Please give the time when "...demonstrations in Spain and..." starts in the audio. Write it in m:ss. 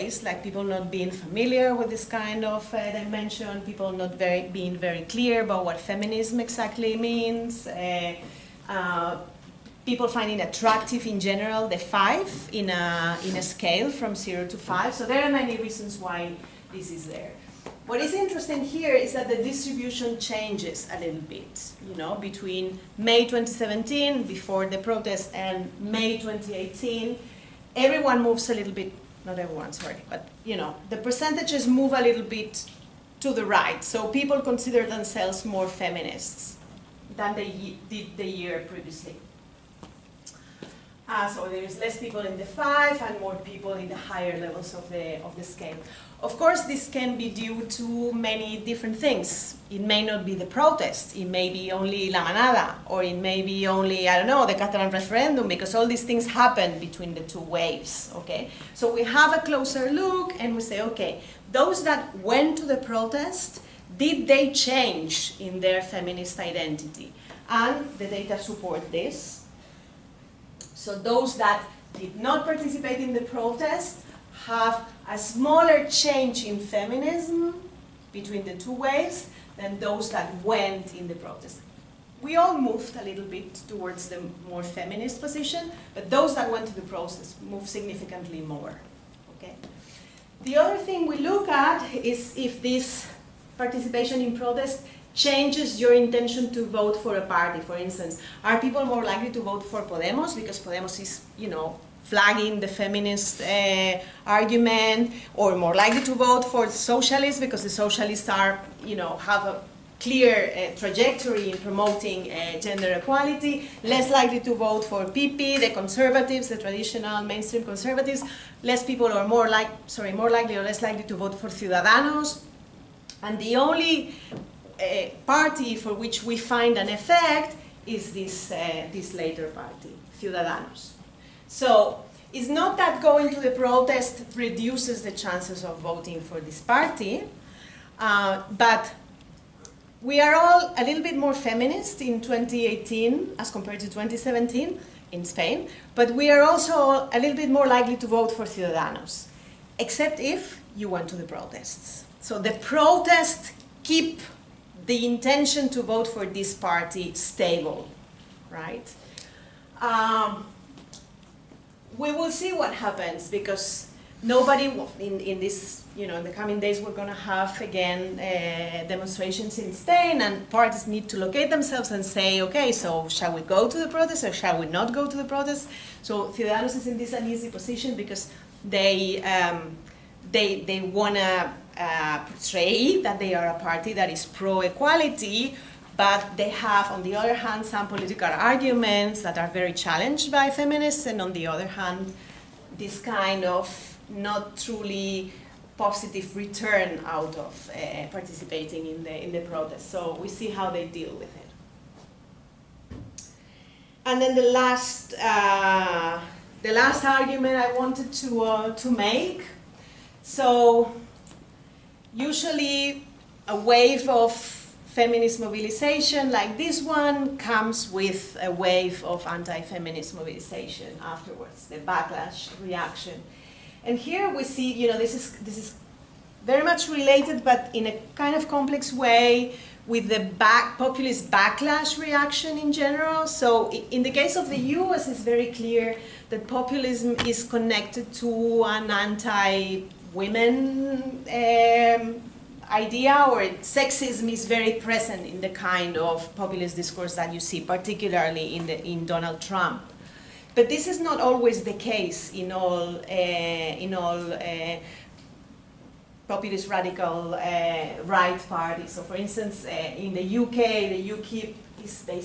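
2:48.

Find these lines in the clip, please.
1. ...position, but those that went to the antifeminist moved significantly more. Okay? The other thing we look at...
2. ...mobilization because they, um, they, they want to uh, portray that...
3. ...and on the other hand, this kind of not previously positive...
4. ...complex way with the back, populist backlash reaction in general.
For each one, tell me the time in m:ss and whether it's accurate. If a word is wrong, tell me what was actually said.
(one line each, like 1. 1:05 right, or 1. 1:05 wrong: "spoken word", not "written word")
1. 1:25 wrong: "protest", not "antifeminist"
2. 2:57 wrong: "position", not "mobilization"
3. 3:11 wrong: "truly", not "previously"
4. 3:48 right.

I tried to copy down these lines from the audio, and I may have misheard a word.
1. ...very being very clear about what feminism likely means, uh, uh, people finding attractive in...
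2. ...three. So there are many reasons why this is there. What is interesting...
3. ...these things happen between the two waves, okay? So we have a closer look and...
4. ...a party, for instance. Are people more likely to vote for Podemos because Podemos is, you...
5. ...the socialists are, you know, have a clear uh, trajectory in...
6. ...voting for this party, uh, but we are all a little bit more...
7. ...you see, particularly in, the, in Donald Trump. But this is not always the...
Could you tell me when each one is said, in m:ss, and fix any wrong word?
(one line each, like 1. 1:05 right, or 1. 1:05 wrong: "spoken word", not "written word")
1. 0:04 wrong: "exactly", not "likely"
2. 0:14 wrong: "five", not "three"
3. 0:55 right
4. 1:37 right
5. 1:47 right
6. 2:15 right
7. 4:07 right.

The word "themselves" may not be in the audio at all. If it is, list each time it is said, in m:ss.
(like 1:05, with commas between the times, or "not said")
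0:34, 2:51.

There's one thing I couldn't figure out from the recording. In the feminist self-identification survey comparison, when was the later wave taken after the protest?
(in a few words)
May 2018.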